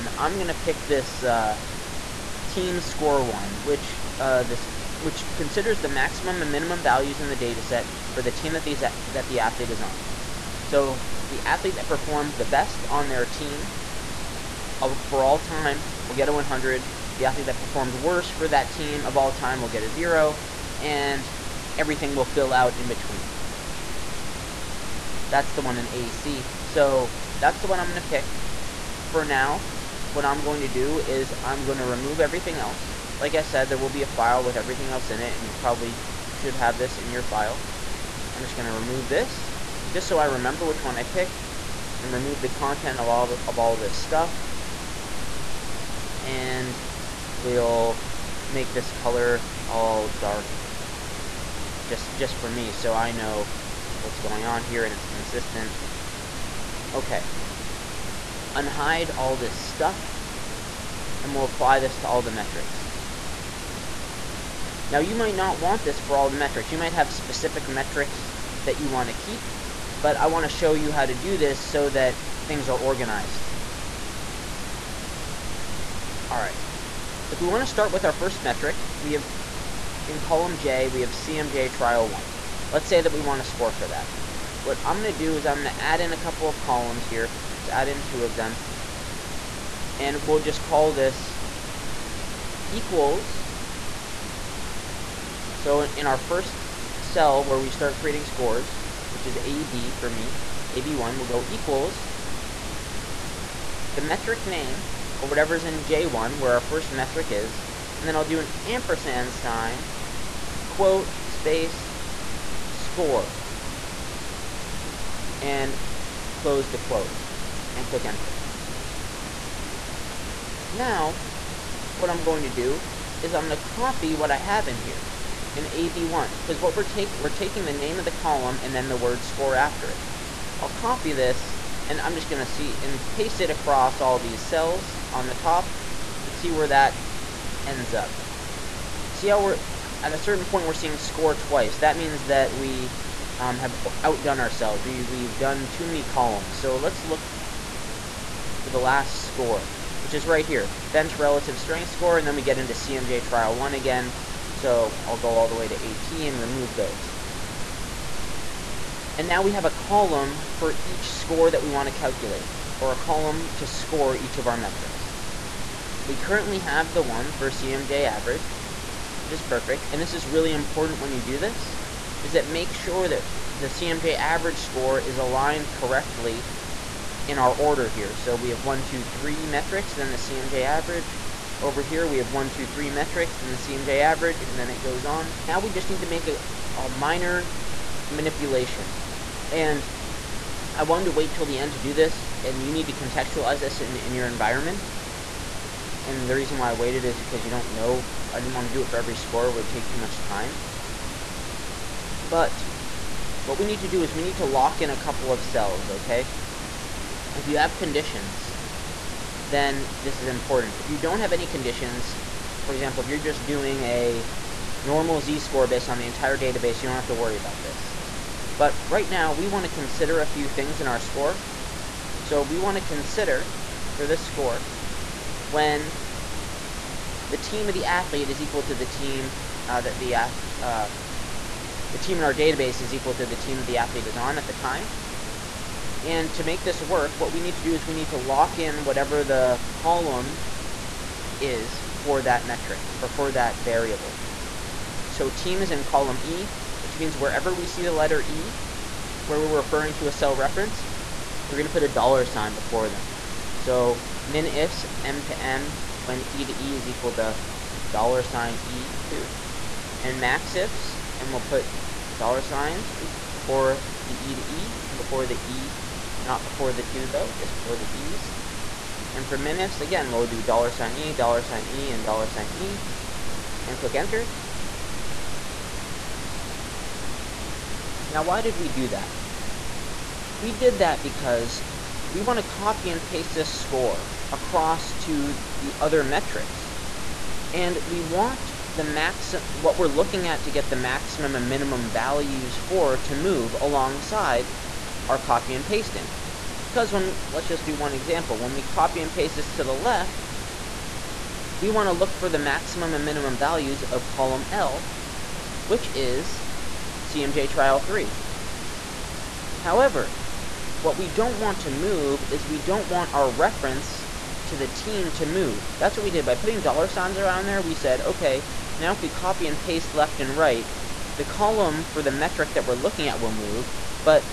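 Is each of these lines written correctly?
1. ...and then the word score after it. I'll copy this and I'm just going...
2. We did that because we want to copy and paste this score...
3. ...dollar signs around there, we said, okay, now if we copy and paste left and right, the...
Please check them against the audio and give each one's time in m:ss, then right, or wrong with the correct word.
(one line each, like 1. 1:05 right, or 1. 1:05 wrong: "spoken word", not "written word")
1. 2:08 right
2. 4:40 right
3. 5:16 right.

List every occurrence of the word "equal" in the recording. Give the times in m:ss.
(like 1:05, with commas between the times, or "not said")
1:32, 1:41, 3:48, 3:52, 4:16.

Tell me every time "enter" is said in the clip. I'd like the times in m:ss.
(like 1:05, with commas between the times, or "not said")
1:58, 4:33.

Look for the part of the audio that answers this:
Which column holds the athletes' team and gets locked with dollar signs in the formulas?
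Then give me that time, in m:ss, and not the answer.
4:05.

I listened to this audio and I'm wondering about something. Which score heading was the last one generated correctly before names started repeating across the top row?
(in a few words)
Bench relative strength score.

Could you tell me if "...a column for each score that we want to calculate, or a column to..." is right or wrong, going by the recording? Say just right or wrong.
right.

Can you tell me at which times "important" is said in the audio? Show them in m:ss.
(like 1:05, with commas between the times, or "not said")
2:50, 3:30.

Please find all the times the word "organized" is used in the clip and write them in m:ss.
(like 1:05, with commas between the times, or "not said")
1:12.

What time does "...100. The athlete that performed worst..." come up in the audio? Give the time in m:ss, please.
0:16.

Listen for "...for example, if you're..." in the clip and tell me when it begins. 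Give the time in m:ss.
3:32.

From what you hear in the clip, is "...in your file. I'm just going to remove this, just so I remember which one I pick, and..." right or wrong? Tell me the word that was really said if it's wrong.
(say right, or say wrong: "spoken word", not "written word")
right.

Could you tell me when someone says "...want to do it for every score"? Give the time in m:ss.
3:18.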